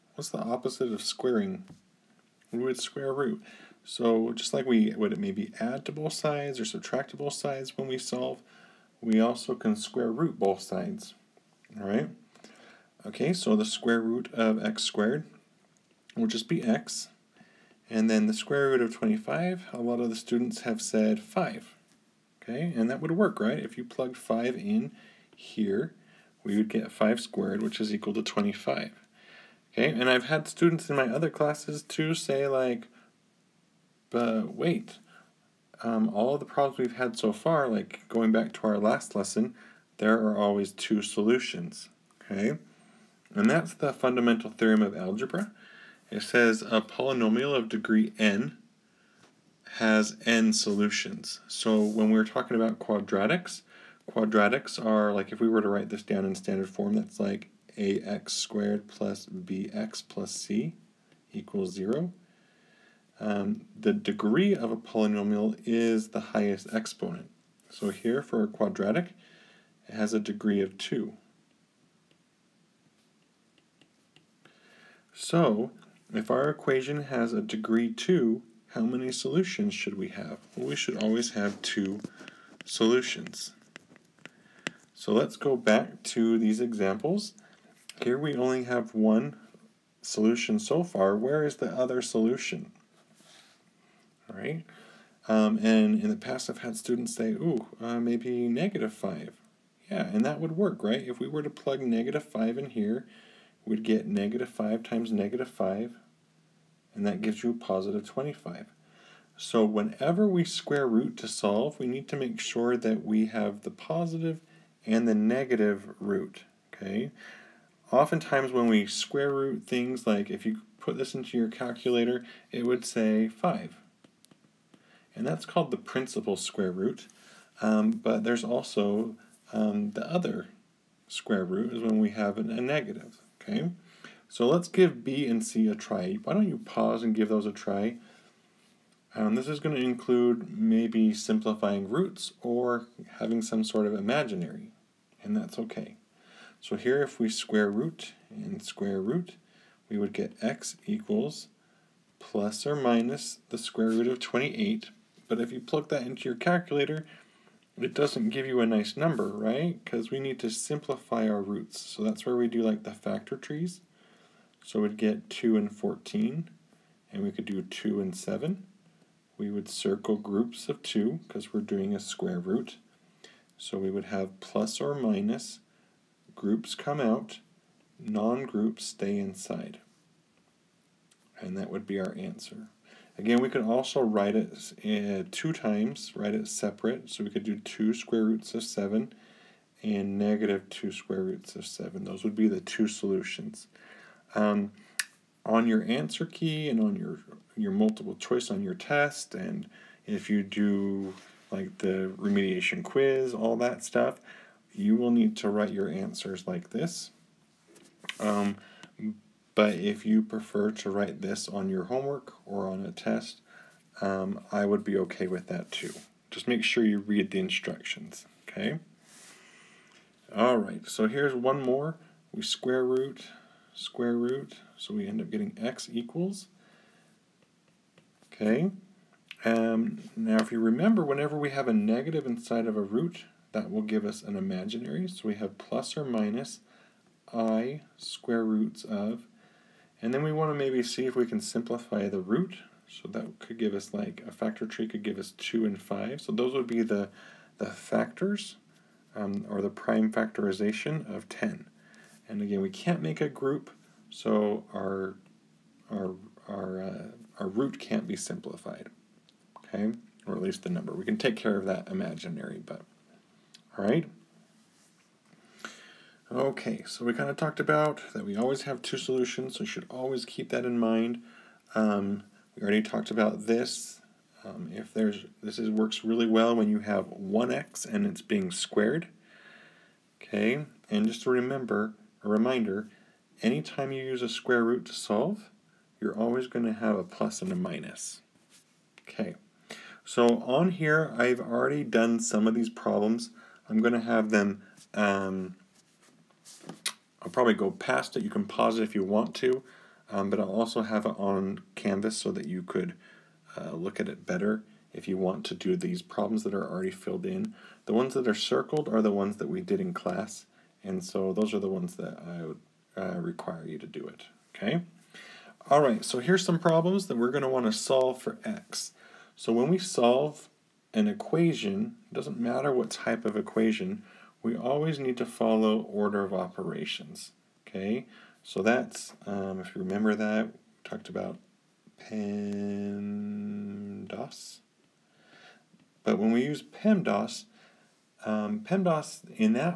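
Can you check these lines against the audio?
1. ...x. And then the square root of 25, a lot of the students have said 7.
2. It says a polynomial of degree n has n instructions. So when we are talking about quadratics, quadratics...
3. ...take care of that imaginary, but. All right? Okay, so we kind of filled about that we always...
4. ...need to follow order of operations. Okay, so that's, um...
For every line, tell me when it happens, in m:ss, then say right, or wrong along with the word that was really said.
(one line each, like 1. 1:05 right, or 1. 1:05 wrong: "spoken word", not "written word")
1. 0:16 wrong: "5", not "7"
2. 0:46 wrong: "solutions", not "instructions"
3. 4:21 wrong: "talked", not "filled"
4. 5:24 right.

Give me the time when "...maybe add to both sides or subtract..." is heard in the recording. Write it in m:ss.
0:05.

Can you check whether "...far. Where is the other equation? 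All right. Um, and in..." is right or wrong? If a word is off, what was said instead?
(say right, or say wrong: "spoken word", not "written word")
wrong: "solution", not "equation".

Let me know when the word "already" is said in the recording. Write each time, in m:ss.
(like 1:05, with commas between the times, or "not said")
4:32, 4:51, 5:06.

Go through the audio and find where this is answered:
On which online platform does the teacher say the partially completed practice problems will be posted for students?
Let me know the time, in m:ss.
5:01.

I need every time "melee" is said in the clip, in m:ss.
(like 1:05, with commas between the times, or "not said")
not said.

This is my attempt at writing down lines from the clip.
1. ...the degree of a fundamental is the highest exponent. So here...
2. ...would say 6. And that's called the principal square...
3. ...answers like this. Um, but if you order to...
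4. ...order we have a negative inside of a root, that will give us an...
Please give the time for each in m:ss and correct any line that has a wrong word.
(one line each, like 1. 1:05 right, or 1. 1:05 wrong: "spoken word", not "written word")
1. 1:03 wrong: "polynomial", not "fundamental"
2. 2:02 wrong: "5", not "6"
3. 3:25 wrong: "prefer", not "order"
4. 3:51 wrong: "whenever", not "order".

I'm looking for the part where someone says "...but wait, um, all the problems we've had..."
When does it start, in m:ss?
0:34.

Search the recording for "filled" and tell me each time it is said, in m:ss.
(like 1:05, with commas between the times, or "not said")
5:06.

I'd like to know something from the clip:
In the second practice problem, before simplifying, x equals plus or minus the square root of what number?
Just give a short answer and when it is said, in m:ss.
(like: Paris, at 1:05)
28, at 2:34.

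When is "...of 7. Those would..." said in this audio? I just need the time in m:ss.
3:11.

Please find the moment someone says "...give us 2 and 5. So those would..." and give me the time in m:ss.
4:05.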